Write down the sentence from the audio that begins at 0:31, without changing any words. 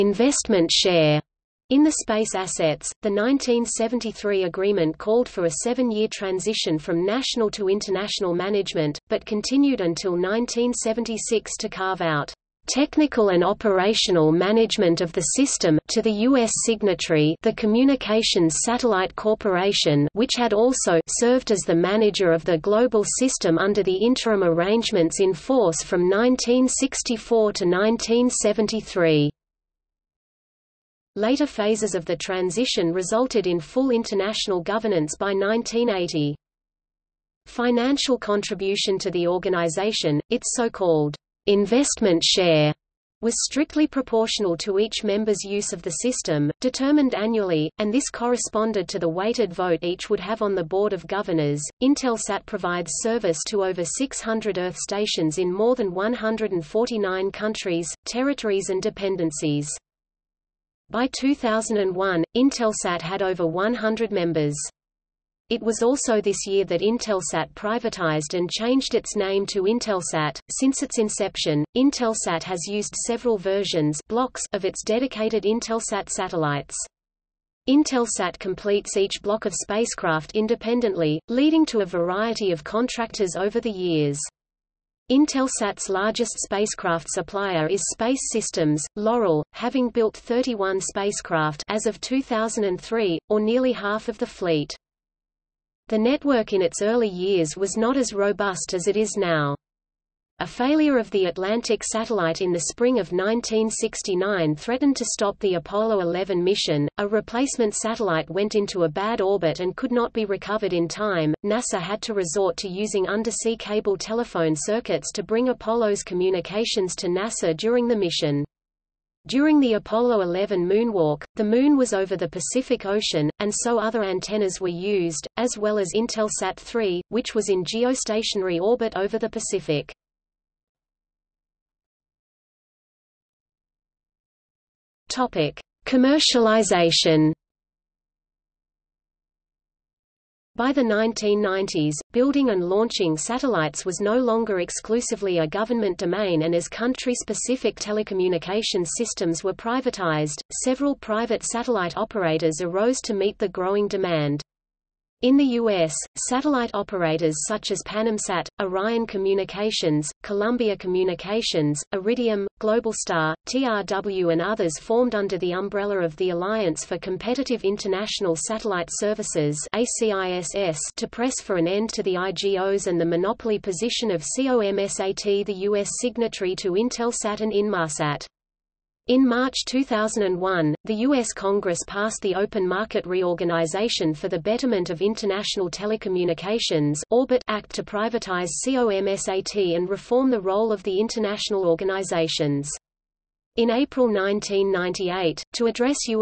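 Later phases of the transition resulted in full international governance by 1980.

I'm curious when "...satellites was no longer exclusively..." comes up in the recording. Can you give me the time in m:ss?
2:23.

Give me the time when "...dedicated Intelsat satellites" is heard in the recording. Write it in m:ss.
1:14.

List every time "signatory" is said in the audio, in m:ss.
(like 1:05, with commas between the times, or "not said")
0:16, 2:55.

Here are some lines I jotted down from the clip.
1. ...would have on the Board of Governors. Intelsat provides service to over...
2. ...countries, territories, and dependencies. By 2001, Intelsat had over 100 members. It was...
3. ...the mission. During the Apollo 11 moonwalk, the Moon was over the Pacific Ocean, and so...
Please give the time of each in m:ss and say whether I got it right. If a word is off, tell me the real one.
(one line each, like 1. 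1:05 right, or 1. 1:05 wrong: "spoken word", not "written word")
1. 0:50 right
2. 0:57 right
3. 1:57 right.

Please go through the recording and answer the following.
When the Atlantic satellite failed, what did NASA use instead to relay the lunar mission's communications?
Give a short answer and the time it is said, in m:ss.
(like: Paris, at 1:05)
undersea cable telephone circuits, at 1:53.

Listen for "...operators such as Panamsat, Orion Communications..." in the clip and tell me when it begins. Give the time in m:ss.
2:36.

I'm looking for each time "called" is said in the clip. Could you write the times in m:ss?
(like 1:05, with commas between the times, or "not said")
0:04, 0:40.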